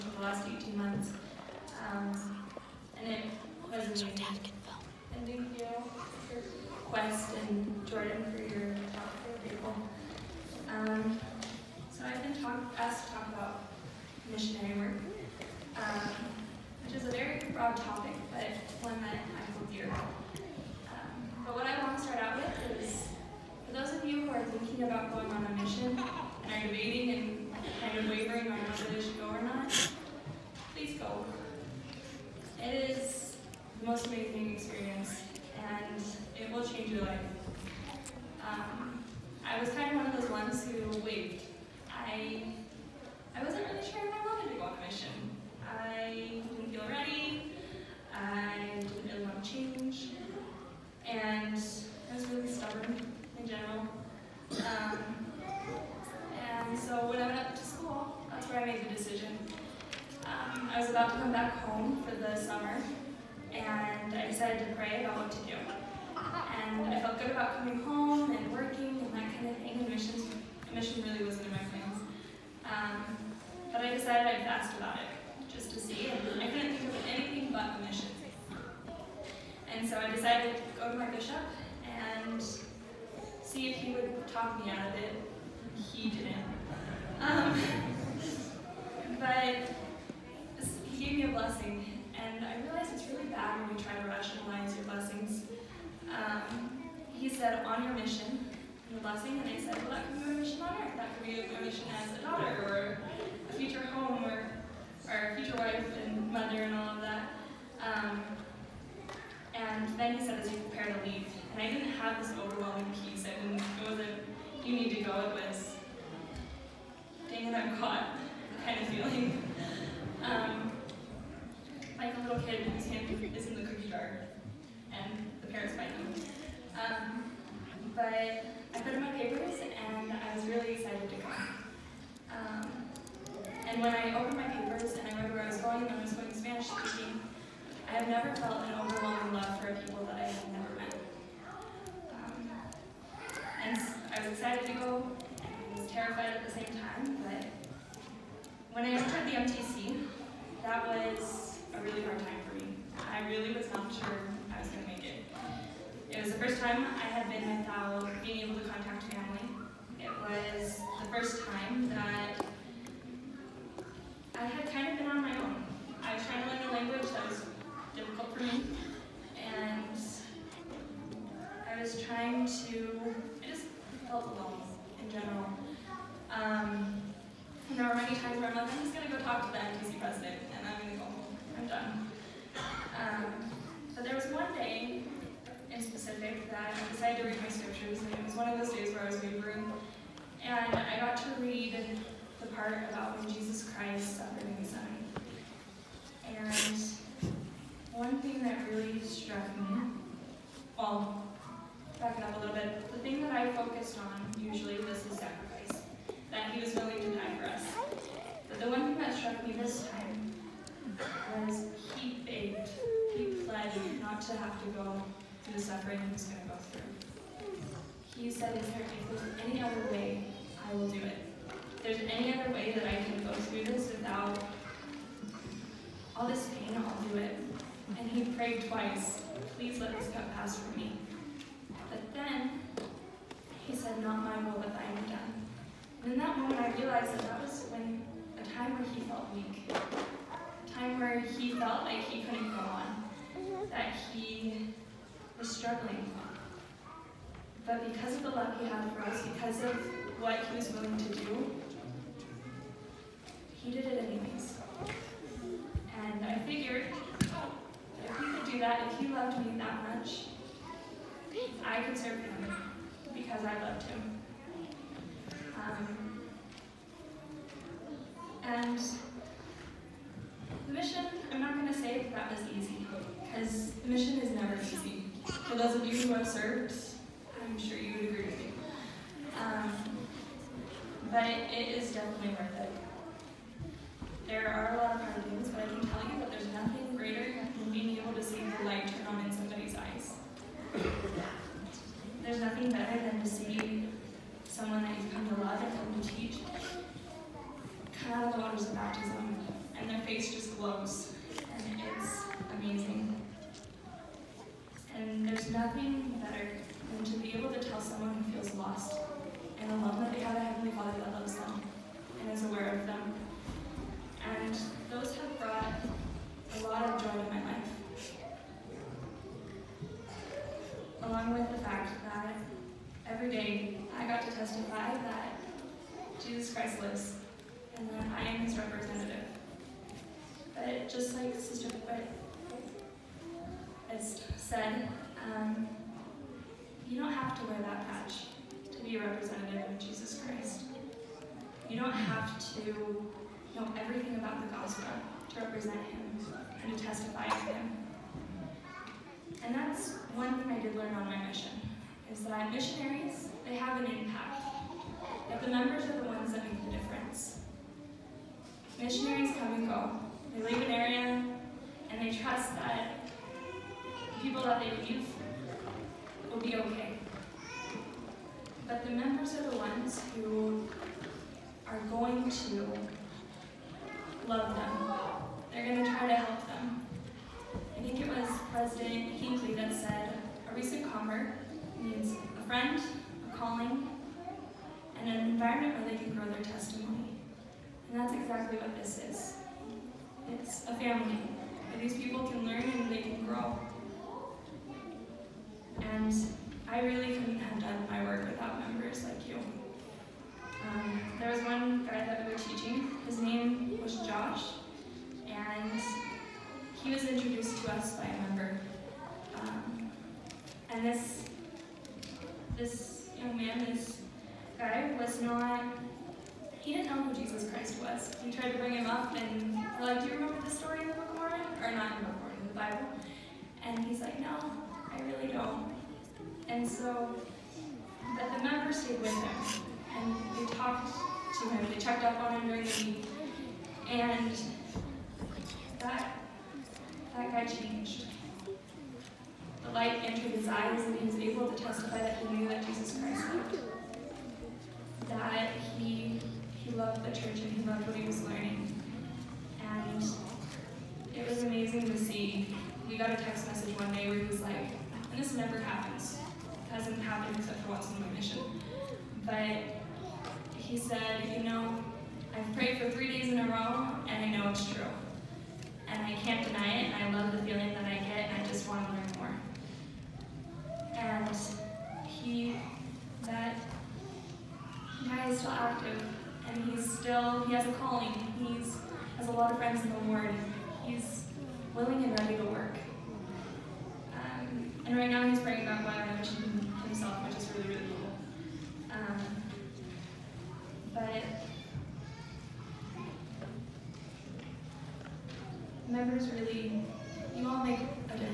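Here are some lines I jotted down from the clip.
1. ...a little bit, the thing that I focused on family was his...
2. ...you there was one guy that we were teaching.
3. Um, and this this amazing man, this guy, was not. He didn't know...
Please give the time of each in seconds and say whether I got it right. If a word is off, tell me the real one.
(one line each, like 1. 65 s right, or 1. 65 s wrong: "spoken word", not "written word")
1. 202 s wrong: "usually", not "family"
2. 399 s right
3. 409 s wrong: "young", not "amazing".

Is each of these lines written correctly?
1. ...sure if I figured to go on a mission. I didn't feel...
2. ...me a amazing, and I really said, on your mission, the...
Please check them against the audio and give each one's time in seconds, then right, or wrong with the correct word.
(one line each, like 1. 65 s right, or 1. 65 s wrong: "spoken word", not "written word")
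1. 43 s wrong: "wanted", not "figured"
2. 91 s wrong: "blessing", not "amazing".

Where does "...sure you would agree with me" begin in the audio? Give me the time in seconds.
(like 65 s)
277 s.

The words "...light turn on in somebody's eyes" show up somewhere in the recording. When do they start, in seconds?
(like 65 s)
288 s.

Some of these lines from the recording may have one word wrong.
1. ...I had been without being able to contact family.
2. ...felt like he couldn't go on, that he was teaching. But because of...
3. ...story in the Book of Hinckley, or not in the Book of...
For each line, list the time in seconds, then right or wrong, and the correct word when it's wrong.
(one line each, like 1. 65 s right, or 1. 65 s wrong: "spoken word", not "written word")
1. 156 s right
2. 241 s wrong: "struggling", not "teaching"
3. 420 s wrong: "Mormon", not "Hinckley".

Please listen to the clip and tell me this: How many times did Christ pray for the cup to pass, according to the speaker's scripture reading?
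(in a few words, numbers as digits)
Twice.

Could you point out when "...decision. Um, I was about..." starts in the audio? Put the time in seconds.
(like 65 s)
58 s.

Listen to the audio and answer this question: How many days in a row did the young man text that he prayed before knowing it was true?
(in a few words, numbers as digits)
3.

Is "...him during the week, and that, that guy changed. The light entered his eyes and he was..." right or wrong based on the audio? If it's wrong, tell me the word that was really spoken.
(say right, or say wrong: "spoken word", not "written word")
right.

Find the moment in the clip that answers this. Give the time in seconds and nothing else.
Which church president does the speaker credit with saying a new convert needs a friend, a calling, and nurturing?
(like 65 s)
378 s.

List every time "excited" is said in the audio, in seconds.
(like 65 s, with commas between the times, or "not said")
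130 s, 144 s.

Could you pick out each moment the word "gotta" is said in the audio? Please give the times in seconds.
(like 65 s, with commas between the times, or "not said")
not said.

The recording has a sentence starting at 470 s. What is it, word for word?
And he, that guy is still active, and he's still, he has a calling.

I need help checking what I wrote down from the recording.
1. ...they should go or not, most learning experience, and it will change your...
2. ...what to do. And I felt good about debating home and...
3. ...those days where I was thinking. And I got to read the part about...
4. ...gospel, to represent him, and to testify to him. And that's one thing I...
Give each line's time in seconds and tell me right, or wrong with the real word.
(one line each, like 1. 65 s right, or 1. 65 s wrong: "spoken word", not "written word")
1. 28 s wrong: "amazing", not "learning"
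2. 65 s wrong: "coming", not "debating"
3. 188 s wrong: "wavering", not "thinking"
4. 344 s right.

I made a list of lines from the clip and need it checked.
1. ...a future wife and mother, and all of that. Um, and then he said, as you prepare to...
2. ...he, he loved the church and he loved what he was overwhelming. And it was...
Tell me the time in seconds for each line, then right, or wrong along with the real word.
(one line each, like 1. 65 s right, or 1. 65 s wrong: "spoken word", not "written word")
1. 105 s right
2. 445 s wrong: "learning", not "overwhelming".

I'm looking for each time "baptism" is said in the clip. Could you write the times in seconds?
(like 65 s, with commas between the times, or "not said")
298 s.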